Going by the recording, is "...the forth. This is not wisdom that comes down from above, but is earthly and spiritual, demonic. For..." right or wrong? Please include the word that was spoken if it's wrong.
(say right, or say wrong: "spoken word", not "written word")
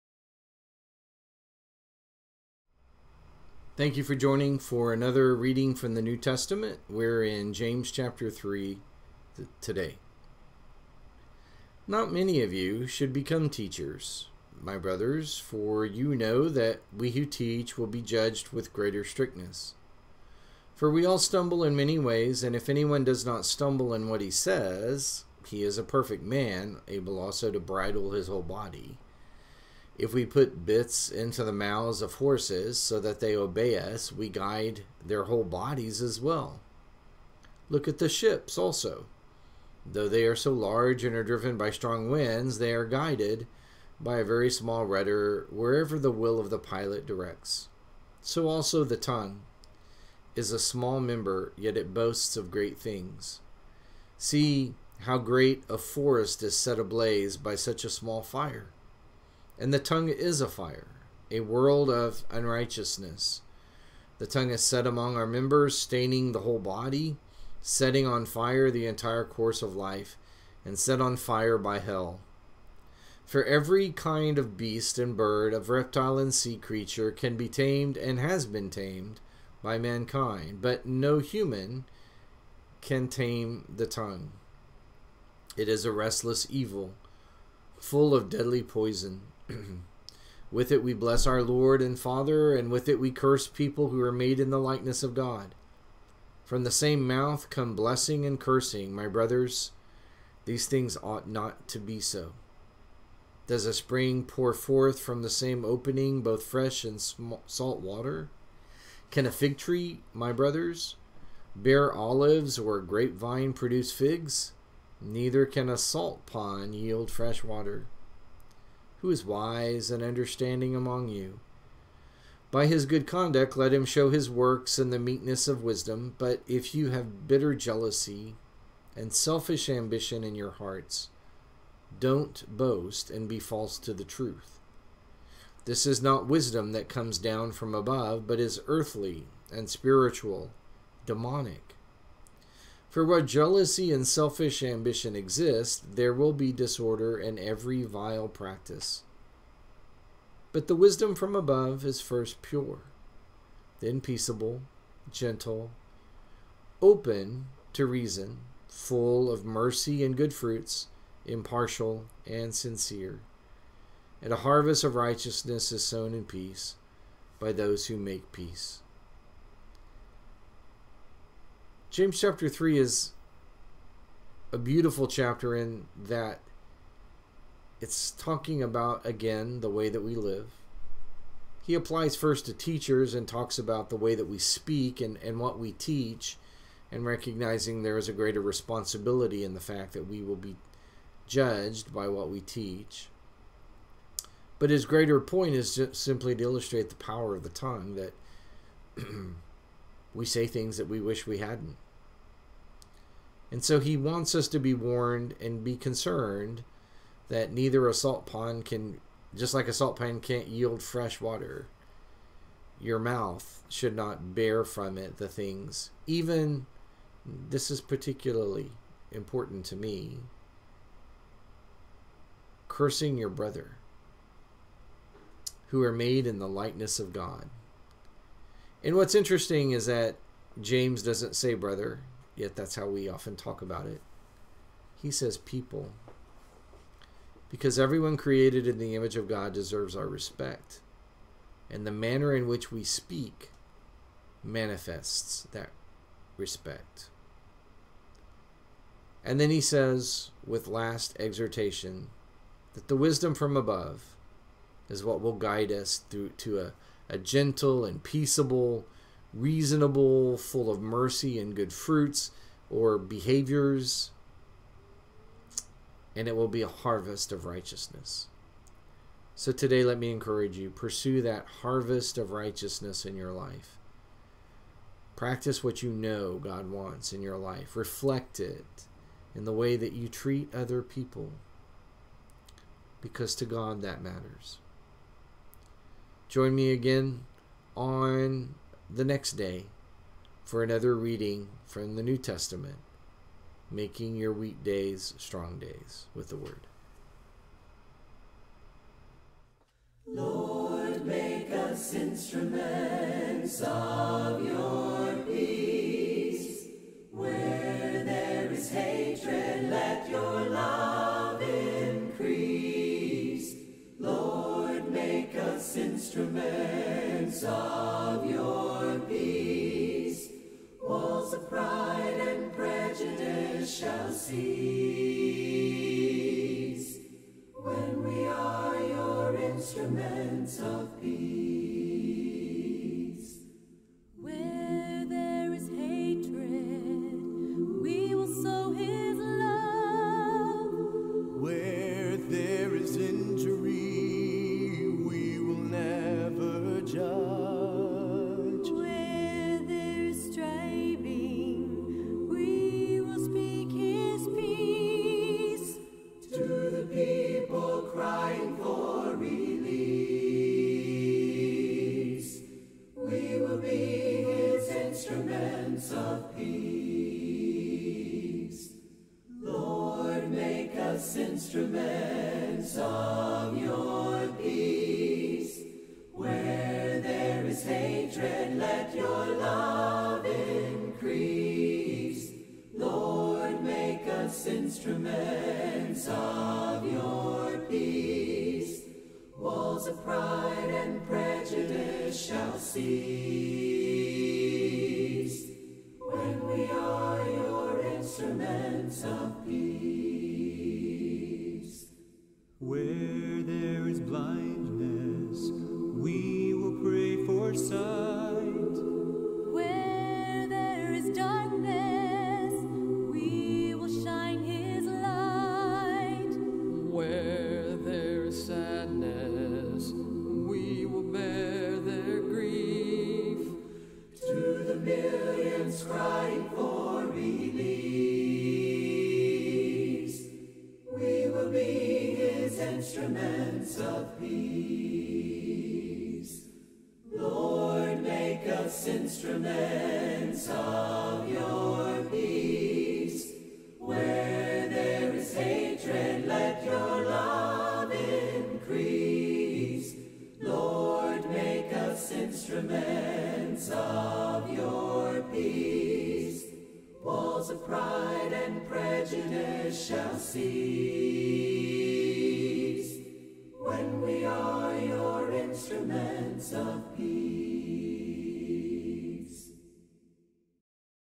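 wrong: "truth", not "forth".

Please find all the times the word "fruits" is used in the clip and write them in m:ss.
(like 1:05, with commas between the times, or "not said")
2:40, 4:21.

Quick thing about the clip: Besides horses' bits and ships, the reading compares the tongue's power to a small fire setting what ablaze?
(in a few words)
a forest.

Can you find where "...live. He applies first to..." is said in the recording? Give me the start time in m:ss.
3:00.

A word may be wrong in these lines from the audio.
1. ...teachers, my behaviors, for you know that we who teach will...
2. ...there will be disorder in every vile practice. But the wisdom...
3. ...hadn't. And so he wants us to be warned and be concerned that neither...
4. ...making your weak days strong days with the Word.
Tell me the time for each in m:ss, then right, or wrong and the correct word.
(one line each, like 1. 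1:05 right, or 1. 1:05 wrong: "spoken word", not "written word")
1. 0:13 wrong: "brothers", not "behaviors"
2. 2:25 right
3. 3:21 right
4. 4:53 right.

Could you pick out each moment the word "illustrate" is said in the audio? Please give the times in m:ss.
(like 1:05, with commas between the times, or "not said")
3:16.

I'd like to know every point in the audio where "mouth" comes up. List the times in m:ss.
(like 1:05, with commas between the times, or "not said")
0:31, 1:37, 3:32.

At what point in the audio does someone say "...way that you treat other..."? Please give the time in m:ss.
4:39.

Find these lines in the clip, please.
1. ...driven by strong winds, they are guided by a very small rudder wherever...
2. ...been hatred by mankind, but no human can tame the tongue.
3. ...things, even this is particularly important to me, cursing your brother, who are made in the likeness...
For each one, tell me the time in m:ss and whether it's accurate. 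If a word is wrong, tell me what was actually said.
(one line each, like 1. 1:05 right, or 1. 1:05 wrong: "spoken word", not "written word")
1. 0:41 right
2. 1:18 wrong: "tamed", not "hatred"
3. 3:35 right.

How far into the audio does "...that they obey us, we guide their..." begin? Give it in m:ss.
0:33.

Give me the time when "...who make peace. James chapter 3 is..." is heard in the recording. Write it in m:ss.
2:47.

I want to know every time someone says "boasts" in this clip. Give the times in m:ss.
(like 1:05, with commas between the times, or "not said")
0:51, 2:12.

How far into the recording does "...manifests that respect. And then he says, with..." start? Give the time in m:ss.
4:04.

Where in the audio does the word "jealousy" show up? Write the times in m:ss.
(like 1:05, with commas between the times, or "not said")
2:07, 2:23.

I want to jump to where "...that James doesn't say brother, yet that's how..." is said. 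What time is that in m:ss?
3:49.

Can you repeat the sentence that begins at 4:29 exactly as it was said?
So today, let me encourage you pursue that harvest of righteousness in your life.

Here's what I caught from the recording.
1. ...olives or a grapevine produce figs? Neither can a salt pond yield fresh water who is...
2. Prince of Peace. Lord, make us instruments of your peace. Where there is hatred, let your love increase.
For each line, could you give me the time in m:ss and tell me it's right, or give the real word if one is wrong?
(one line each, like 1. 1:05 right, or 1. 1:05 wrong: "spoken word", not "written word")
1. 1:51 right
2. 7:13 right.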